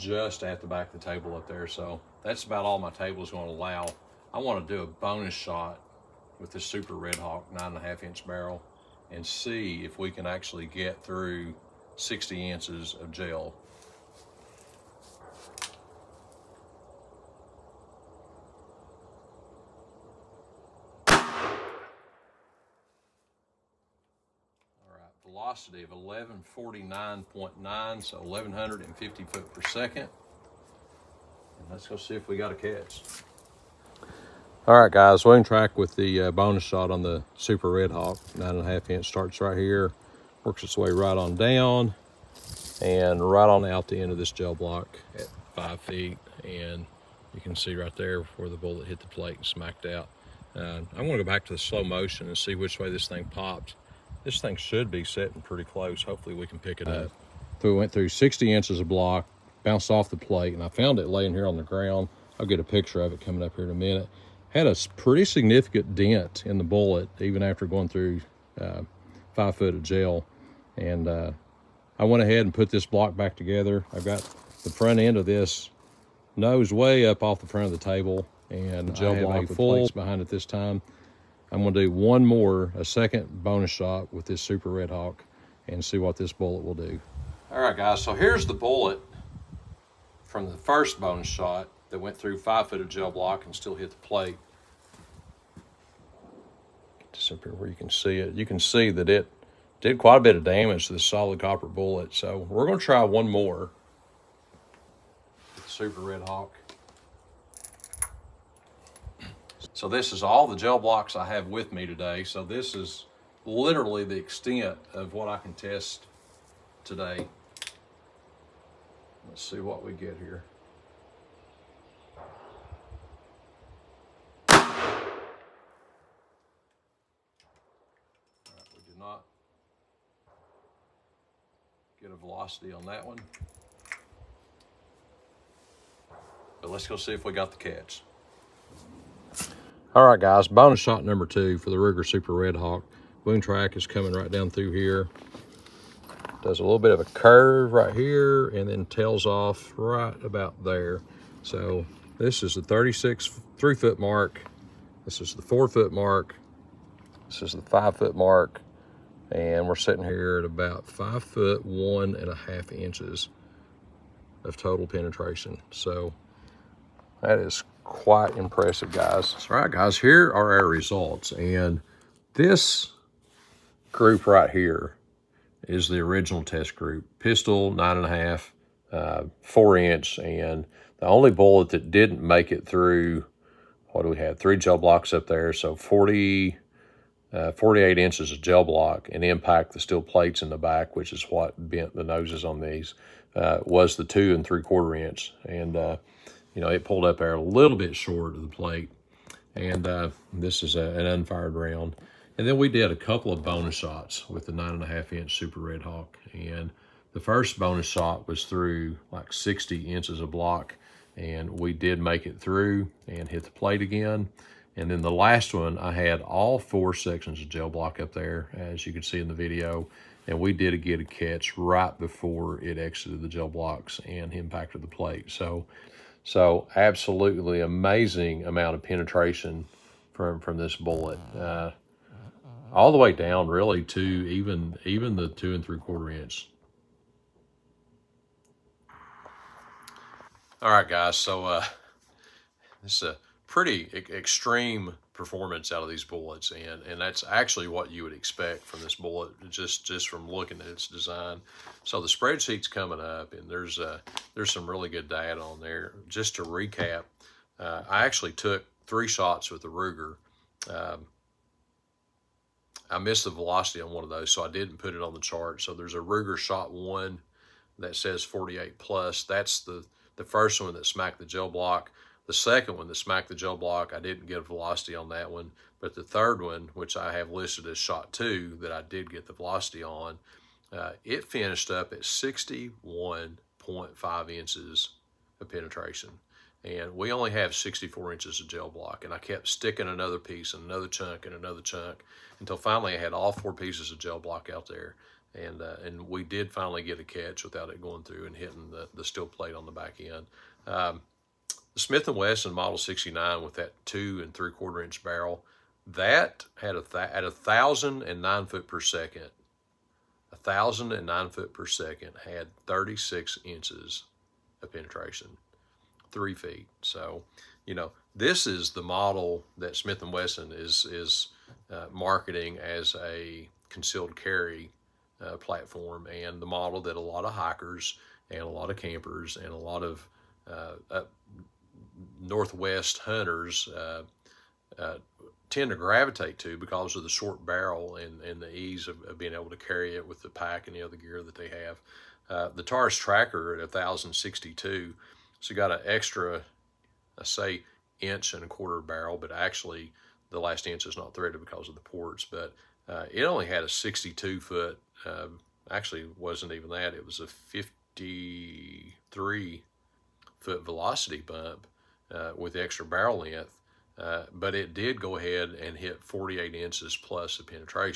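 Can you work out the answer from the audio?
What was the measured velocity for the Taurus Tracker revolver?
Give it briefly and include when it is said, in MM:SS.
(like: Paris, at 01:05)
1062 fps, at 05:43.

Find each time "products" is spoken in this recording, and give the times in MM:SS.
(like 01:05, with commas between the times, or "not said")
not said.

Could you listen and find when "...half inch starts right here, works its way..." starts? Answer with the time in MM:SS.
00:38.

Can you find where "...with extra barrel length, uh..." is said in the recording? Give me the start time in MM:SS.
06:02.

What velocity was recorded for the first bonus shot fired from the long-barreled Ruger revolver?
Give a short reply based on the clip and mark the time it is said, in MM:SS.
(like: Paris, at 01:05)
1149.9 fps, at 00:25.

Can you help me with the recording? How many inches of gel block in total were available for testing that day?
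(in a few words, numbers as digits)
64 inches.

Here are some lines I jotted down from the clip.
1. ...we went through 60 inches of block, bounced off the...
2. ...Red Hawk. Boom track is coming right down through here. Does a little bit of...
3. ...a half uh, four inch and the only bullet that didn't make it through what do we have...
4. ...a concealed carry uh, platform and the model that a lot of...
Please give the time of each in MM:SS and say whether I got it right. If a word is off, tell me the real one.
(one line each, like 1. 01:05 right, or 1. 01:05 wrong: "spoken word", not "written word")
1. 00:57 right
2. 02:22 right
3. 02:58 right
4. 05:23 right.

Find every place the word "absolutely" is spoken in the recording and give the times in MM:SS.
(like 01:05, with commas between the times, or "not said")
03:46.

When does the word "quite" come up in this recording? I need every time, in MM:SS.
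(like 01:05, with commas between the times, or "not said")
01:39, 02:47.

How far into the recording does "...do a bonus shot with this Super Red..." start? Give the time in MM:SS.
00:04.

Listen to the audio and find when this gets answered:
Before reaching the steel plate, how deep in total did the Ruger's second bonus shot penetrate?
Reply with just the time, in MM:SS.
04:42.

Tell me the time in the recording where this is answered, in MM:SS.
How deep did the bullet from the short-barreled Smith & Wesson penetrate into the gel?
05:12.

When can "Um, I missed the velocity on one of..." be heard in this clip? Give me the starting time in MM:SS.
04:20.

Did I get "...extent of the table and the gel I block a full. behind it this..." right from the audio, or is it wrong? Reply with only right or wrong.
wrong.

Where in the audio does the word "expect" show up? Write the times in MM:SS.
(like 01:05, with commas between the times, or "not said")
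04:08.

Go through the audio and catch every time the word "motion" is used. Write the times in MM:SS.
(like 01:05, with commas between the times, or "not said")
00:51.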